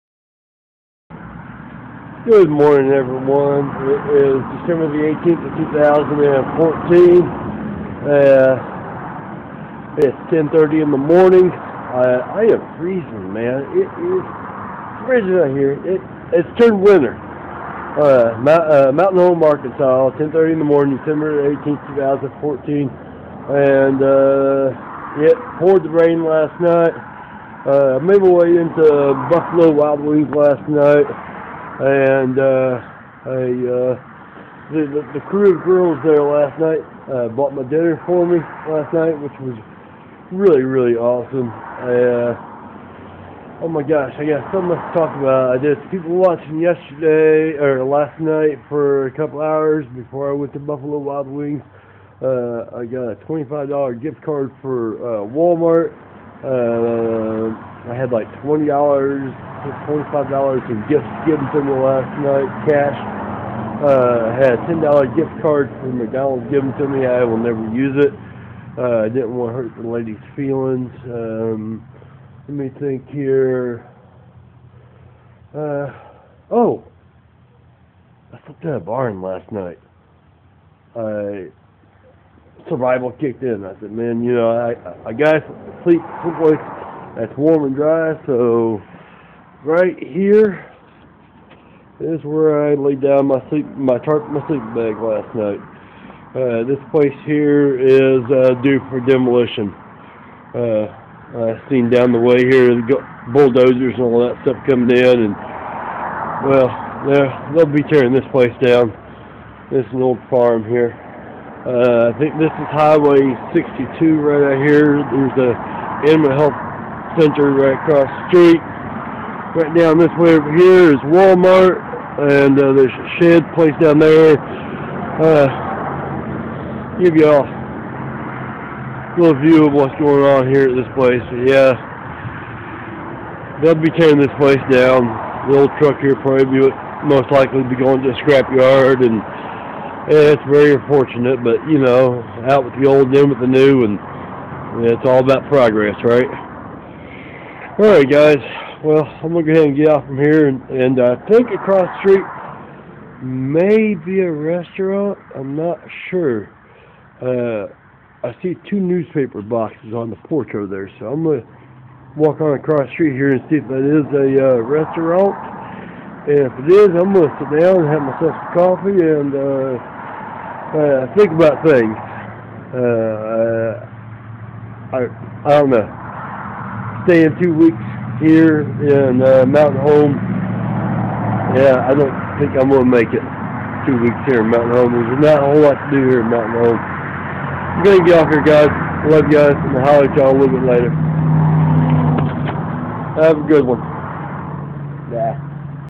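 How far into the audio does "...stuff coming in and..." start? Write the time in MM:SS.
01:44.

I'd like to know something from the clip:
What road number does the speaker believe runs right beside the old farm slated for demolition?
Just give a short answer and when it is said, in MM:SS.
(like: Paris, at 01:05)
62, at 01:53.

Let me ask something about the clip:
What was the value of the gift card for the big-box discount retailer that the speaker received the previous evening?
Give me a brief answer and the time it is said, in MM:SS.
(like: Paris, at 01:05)
$25, at 00:53.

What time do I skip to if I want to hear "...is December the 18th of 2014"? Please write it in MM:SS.
00:04.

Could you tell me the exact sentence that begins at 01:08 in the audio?
Uh, I didn't want to hurt the lady's feelings.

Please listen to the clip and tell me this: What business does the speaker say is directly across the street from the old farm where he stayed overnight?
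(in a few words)
Animal health center.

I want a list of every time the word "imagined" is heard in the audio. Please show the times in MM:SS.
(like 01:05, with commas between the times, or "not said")
not said.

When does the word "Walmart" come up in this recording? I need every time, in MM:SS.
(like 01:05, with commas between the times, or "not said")
00:55, 02:01.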